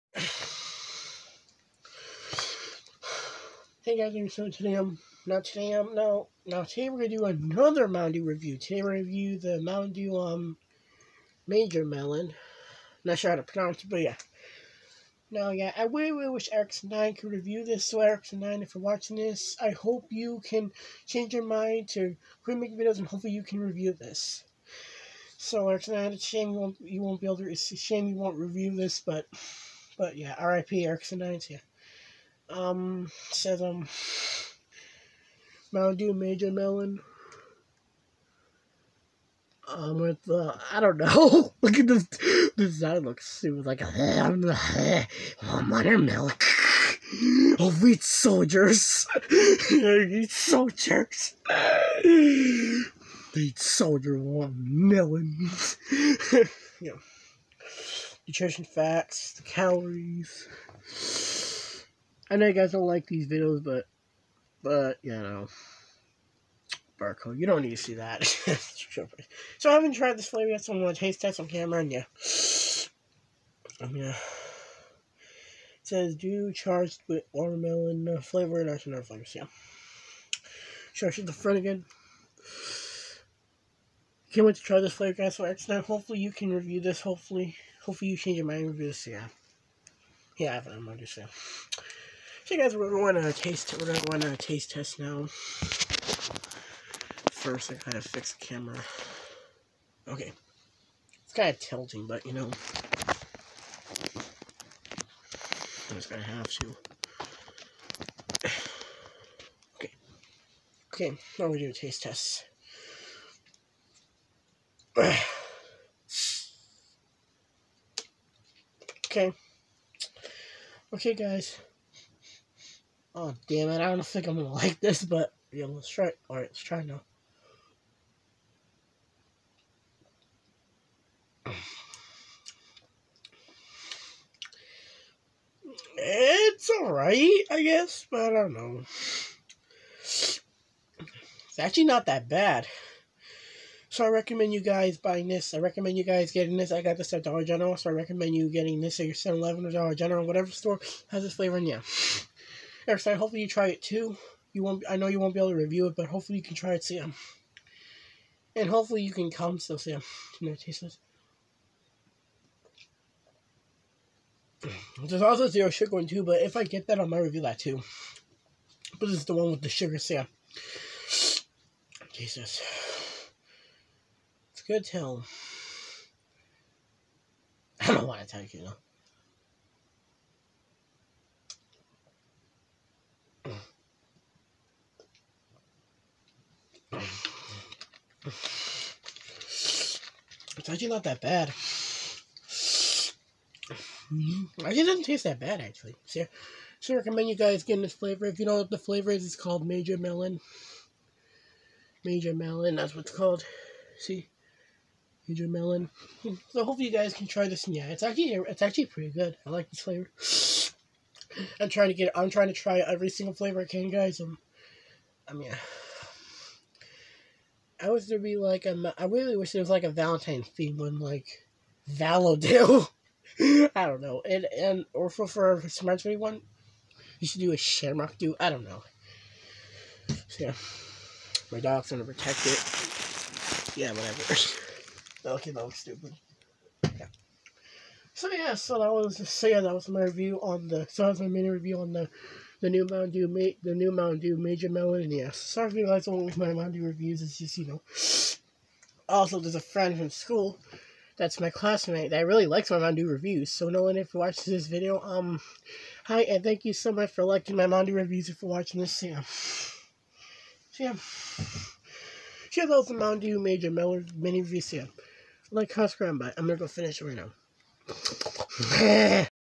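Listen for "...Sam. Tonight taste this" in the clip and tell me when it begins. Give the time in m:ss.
2:39.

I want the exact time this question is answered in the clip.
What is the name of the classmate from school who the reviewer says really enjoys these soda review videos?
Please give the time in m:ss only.
4:13.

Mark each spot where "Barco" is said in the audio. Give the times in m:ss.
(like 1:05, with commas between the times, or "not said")
1:06.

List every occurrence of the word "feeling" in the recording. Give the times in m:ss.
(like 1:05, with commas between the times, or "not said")
not said.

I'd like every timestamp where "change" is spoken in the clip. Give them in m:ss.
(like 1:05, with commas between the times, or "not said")
0:21, 1:28.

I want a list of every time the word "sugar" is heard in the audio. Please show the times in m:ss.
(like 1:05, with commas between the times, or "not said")
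2:45, 2:49.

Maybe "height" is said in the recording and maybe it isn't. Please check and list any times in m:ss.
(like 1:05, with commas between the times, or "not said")
not said.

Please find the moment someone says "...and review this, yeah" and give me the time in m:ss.
1:28.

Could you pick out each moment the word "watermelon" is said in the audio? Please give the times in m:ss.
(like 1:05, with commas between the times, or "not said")
0:45, 1:17.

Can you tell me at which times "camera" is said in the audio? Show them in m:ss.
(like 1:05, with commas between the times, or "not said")
1:11, 1:38.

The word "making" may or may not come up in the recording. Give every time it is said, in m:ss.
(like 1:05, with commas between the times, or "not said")
0:22.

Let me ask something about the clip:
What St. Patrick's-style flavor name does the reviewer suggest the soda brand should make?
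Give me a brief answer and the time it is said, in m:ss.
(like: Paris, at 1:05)
Shamrock Dew, at 3:47.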